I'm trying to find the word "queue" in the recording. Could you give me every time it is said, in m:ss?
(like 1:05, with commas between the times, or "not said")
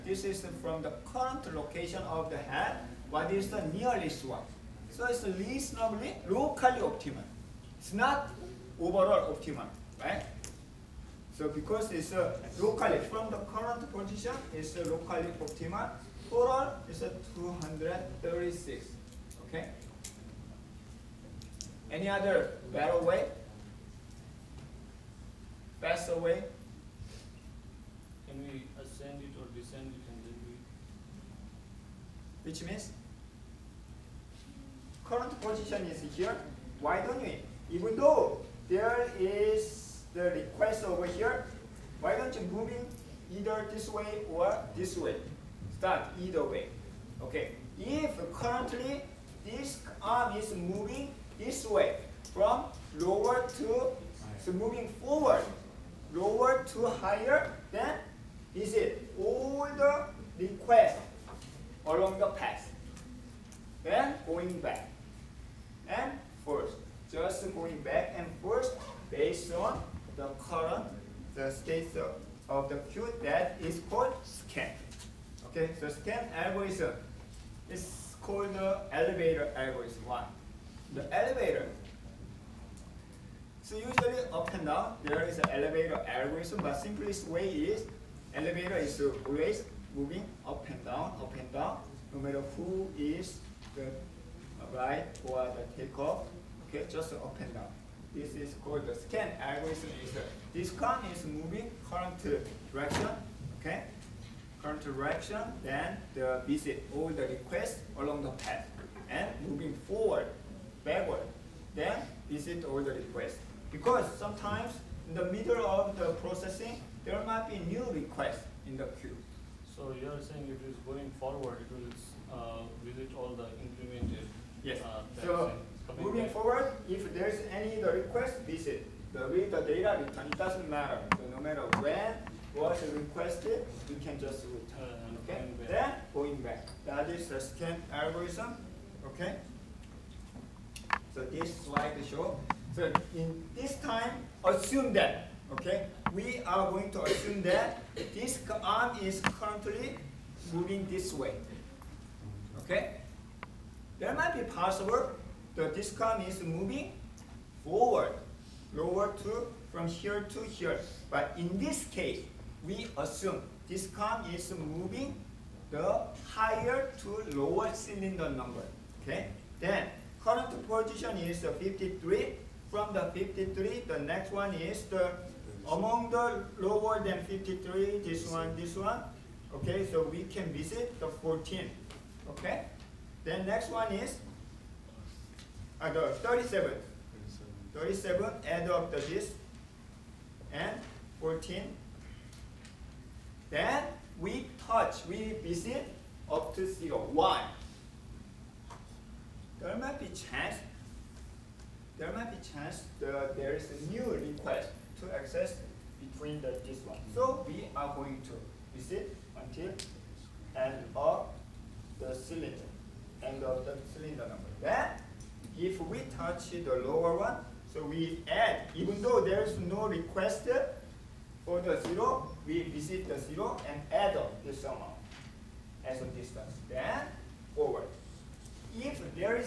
1:12, 1:58.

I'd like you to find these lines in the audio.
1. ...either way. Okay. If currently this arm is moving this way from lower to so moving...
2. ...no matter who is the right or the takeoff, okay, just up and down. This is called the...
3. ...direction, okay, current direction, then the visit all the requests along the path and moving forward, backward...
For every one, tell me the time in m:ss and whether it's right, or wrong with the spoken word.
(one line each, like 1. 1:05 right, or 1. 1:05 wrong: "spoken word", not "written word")
1. 0:46 right
2. 1:32 right
3. 1:42 right.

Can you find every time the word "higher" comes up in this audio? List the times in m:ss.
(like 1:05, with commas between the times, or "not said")
0:56, 2:46.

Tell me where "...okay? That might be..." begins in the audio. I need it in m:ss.
2:32.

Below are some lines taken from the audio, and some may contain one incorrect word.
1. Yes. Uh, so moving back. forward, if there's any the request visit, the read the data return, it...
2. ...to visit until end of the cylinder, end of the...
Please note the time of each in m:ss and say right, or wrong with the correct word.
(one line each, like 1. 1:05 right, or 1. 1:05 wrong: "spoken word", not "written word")
1. 2:04 right
2. 3:28 right.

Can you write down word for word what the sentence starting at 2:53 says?
The next one is the among the lower than 53, this one, this one.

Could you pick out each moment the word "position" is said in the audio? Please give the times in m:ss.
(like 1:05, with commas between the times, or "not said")
0:13, 0:35, 2:50.